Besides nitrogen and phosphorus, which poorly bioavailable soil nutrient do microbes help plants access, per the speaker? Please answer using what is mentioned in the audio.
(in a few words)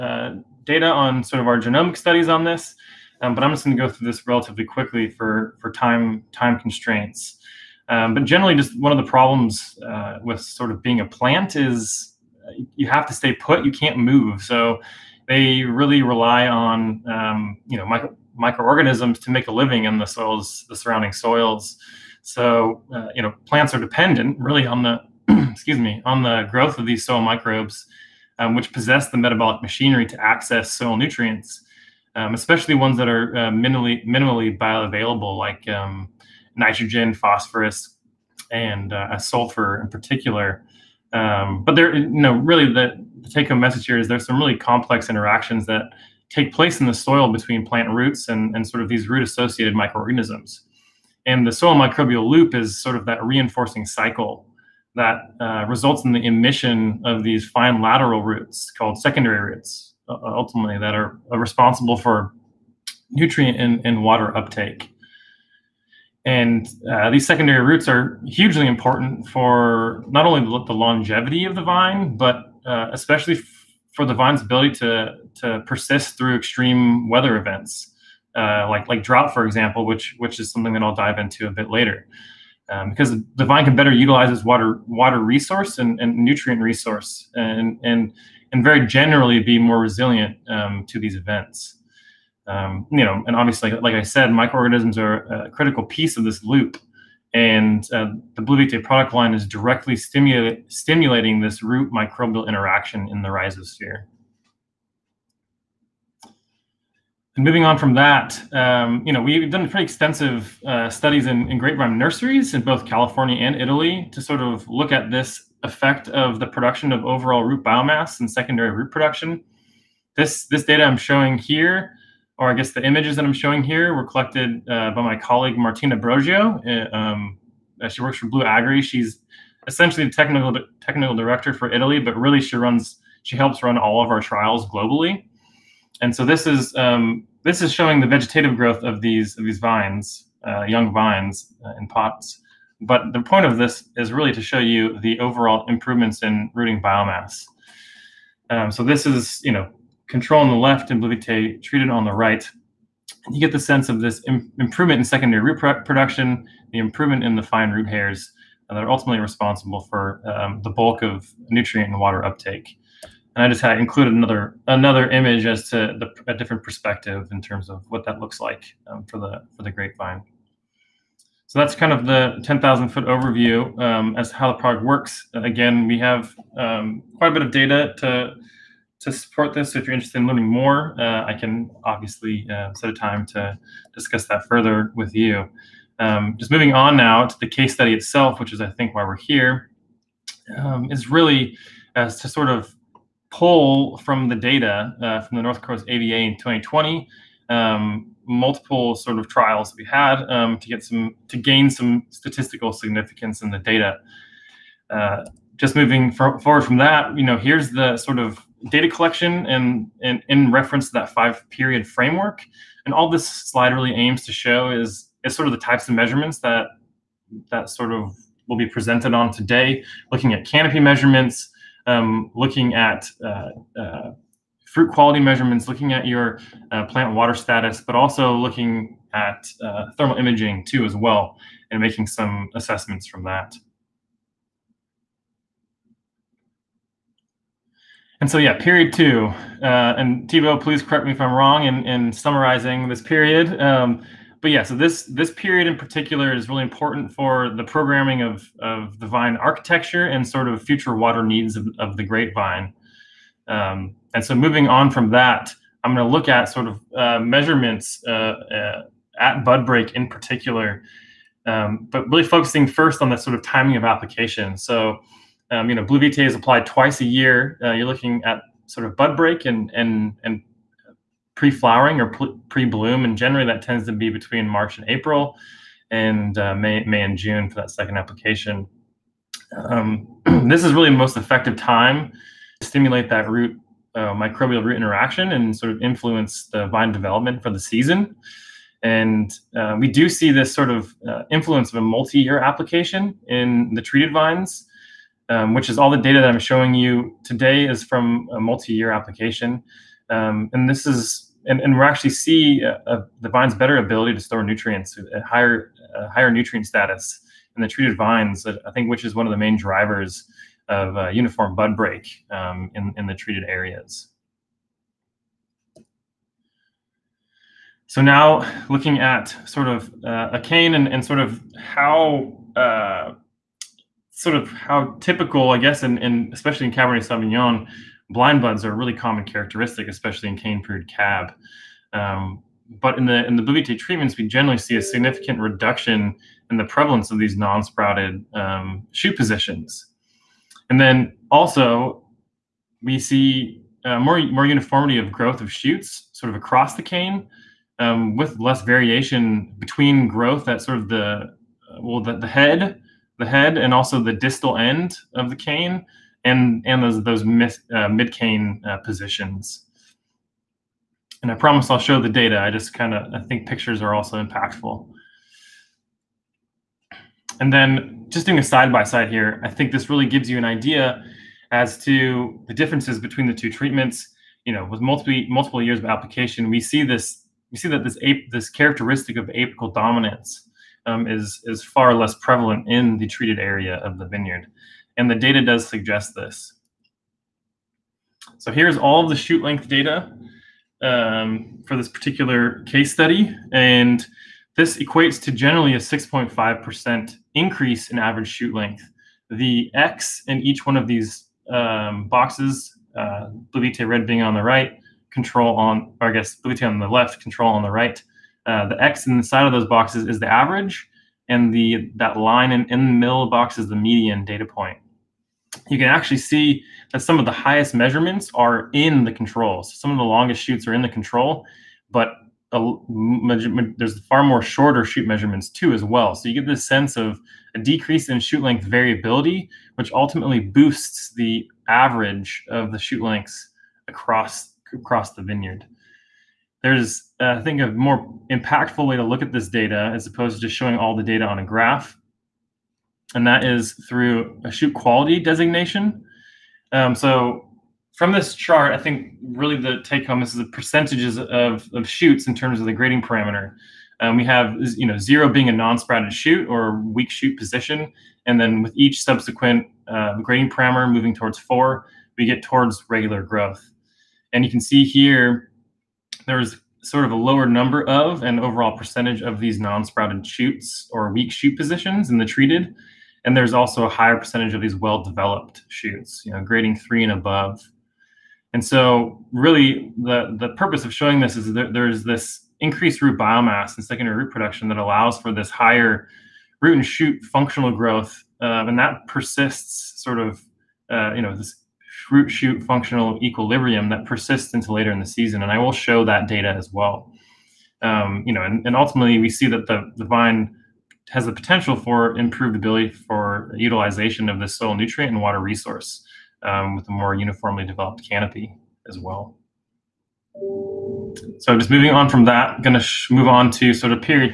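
sulfur.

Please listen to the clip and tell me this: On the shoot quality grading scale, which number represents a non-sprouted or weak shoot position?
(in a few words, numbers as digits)
0.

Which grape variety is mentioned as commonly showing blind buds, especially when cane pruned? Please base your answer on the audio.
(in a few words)
Cabernet Sauvignon.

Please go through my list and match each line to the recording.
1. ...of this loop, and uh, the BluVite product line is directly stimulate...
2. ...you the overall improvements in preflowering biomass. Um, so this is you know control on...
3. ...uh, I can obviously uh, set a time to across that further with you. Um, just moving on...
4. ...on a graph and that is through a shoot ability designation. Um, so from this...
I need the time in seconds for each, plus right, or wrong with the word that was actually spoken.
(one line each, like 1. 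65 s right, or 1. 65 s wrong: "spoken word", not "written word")
1. 96 s right
2. 144 s wrong: "rooting", not "preflowering"
3. 180 s wrong: "discuss", not "across"
4. 441 s wrong: "quality", not "ability".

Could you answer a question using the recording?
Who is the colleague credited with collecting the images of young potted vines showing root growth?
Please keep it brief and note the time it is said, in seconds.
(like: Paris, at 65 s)
Martina Brogio, at 125 s.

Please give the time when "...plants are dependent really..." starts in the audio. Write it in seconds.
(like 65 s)
23 s.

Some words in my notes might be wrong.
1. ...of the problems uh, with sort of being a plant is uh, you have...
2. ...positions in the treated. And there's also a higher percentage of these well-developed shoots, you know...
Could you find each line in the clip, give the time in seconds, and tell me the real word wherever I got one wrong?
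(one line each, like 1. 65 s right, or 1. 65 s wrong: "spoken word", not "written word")
1. 8 s right
2. 471 s right.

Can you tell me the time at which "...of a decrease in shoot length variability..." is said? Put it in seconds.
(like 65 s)
426 s.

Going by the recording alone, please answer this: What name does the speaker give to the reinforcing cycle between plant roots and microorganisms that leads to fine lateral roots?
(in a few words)
soil microbial loop.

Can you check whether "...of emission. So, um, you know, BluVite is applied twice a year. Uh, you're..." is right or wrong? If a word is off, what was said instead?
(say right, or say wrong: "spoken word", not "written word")
wrong: "application", not "emission".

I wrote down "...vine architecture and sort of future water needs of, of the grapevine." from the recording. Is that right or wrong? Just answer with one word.
right.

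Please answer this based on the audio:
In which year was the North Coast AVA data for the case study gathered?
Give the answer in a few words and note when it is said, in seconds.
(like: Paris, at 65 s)
2020, at 196 s.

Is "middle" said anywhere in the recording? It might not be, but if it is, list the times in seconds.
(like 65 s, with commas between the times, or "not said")
412 s.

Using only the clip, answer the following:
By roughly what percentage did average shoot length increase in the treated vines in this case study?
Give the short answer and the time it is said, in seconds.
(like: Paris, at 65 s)
6.5%, at 395 s.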